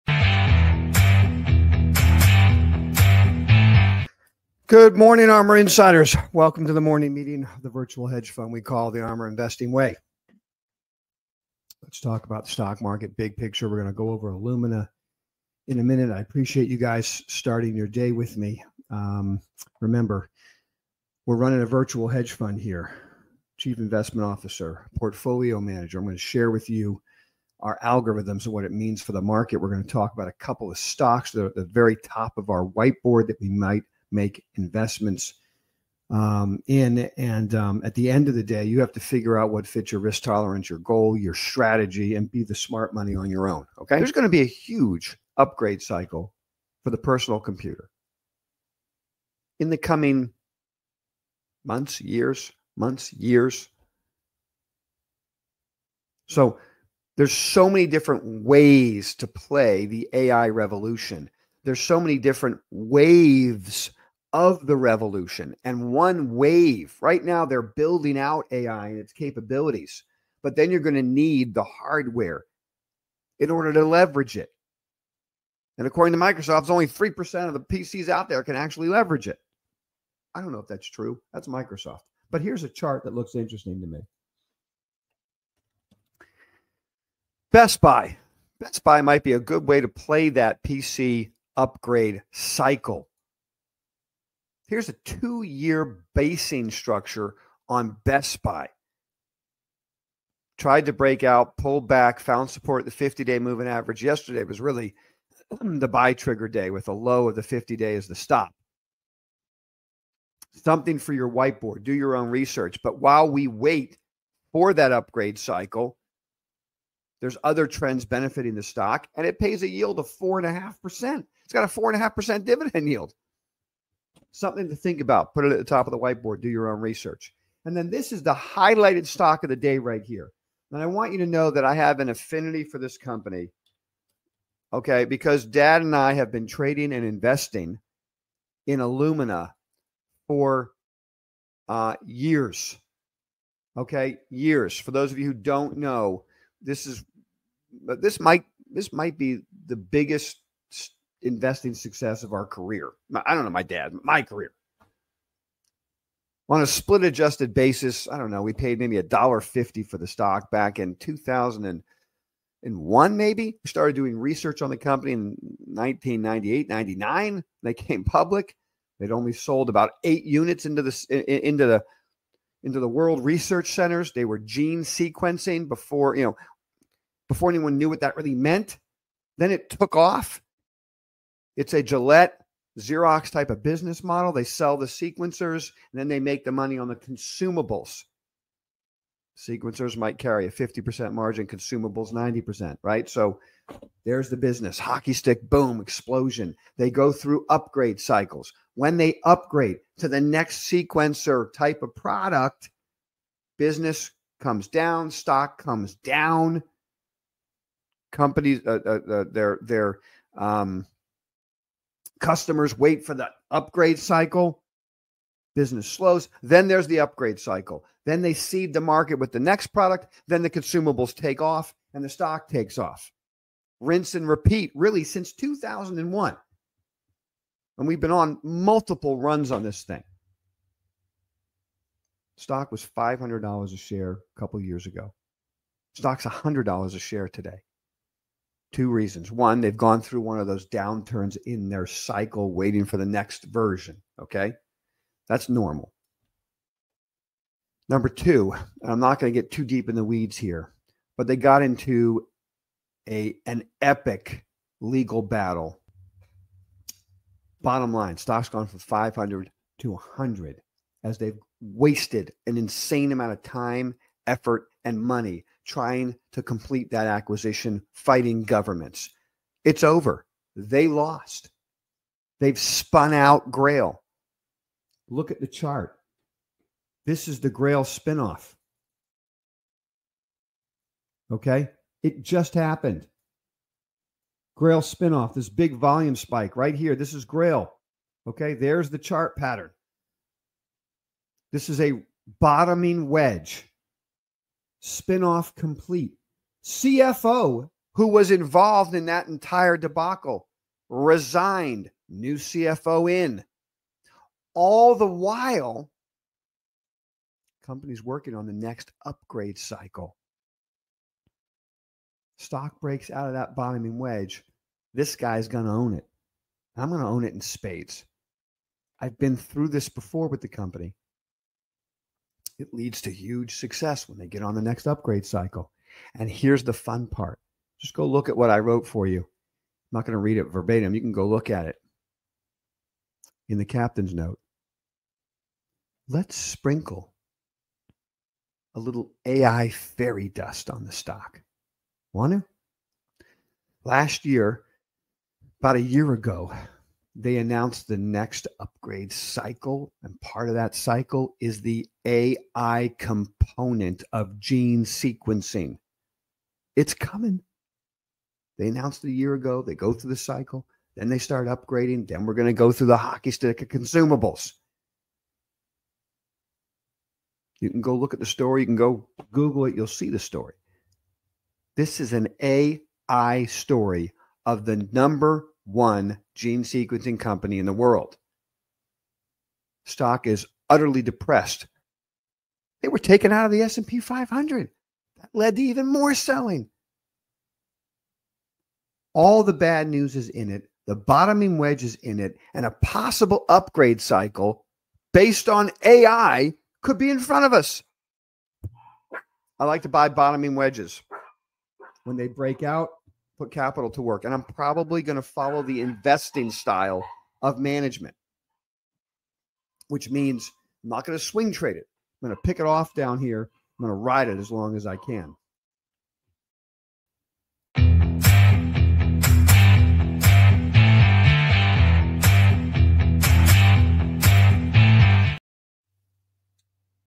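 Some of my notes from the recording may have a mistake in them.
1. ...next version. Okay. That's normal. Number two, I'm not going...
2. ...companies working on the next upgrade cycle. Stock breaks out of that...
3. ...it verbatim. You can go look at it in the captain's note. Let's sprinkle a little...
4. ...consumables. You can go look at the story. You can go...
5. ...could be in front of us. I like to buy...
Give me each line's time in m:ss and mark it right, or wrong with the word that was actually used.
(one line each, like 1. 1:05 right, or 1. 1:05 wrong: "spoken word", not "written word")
1. 4:03 right
2. 5:07 right
3. 5:30 right
4. 6:03 right
5. 6:36 right.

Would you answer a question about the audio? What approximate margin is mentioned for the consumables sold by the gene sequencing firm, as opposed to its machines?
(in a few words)
90%.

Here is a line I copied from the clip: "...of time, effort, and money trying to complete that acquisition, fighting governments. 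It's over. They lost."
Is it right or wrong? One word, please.
right.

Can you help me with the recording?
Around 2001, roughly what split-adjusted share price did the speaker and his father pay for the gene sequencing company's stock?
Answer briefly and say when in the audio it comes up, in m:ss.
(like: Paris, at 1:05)
$1.50, at 2:38.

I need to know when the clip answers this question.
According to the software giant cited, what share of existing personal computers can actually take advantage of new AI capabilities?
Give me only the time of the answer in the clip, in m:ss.
1:16.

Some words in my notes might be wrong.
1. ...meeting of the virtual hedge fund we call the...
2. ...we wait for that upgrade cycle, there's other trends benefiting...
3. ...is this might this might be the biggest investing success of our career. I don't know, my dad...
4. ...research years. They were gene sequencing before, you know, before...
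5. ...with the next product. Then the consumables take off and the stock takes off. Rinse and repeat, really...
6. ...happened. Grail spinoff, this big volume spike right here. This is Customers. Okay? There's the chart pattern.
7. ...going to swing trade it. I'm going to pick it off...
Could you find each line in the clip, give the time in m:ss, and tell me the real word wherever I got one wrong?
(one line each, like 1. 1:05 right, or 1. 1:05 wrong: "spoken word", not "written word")
1. 0:07 right
2. 1:53 right
3. 2:26 right
4. 2:53 wrong: "centers", not "years"
5. 3:39 right
6. 4:42 wrong: "Grail", not "Customers"
7. 6:51 right.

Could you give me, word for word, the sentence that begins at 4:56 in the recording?
CFO, who was involved in that entire debacle, resigned, new CFO in.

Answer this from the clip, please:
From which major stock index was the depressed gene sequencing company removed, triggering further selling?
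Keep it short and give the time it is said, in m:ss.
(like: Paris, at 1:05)
S&P 500, at 6:23.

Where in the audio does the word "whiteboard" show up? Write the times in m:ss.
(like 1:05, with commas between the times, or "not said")
0:32, 1:51, 2:05.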